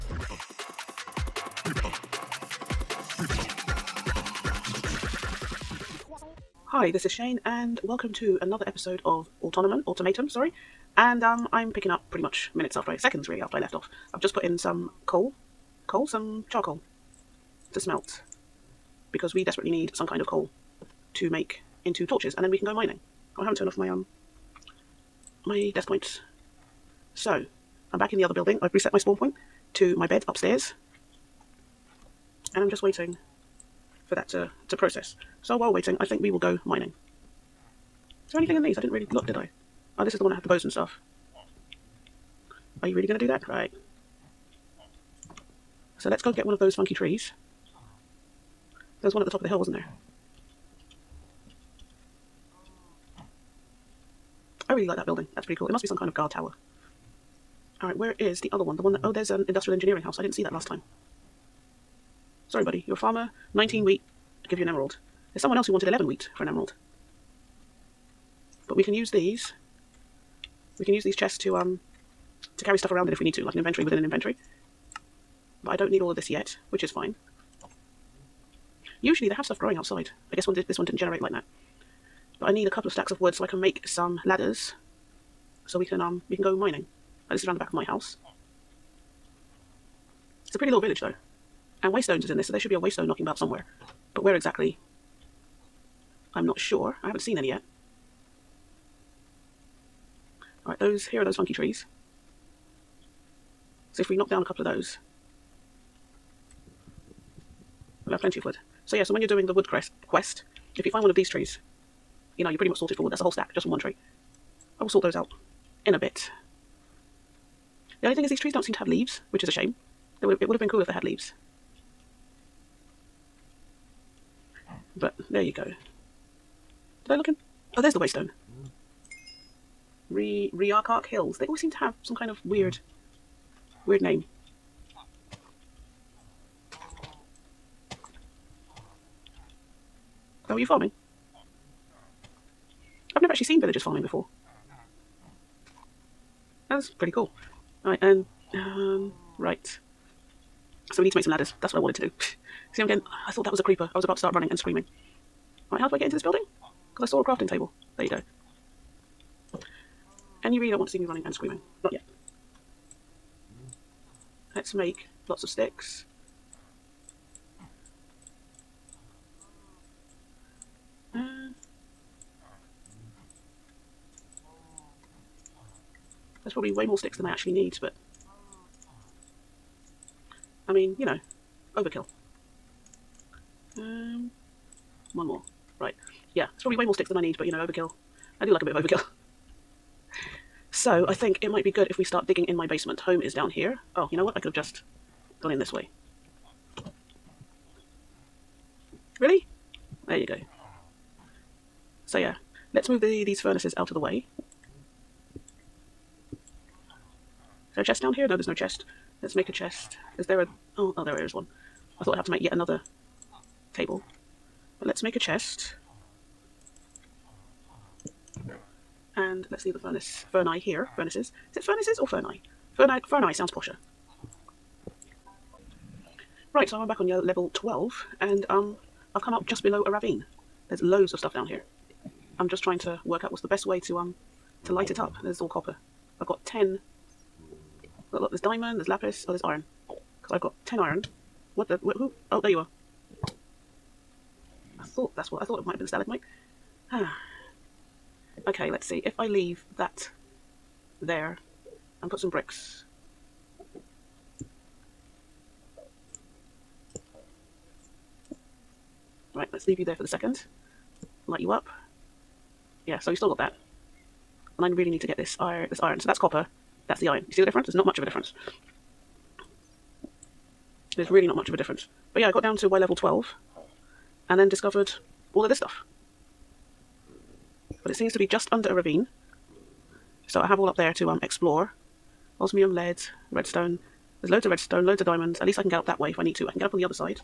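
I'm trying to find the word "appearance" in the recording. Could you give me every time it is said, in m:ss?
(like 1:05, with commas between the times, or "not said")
not said.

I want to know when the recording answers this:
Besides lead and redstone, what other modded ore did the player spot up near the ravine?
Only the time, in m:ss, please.
4:42.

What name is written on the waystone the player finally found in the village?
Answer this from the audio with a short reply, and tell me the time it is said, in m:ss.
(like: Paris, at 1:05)
Riarkark Hills, at 2:10.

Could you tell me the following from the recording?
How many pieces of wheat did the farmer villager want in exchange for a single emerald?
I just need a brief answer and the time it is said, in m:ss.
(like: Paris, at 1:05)
19, at 1:03.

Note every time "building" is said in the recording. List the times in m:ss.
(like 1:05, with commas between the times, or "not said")
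0:28, 0:55, 2:36.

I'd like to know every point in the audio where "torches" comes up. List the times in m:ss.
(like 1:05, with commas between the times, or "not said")
0:22.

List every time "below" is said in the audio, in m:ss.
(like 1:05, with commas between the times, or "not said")
3:49.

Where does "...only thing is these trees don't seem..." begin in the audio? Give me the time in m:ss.
1:58.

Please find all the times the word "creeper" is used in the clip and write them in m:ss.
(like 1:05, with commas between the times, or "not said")
2:33.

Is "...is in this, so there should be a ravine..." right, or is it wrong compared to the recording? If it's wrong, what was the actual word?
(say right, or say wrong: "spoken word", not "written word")
wrong: "waystone", not "ravine".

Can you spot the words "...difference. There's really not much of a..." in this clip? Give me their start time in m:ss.
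4:28.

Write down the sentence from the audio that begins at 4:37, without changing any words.
But it seems to be just under a ravine.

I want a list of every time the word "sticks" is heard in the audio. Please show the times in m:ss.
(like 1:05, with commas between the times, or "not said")
2:45, 2:56, 3:06.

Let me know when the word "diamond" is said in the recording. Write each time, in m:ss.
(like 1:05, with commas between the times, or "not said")
3:58, 4:45.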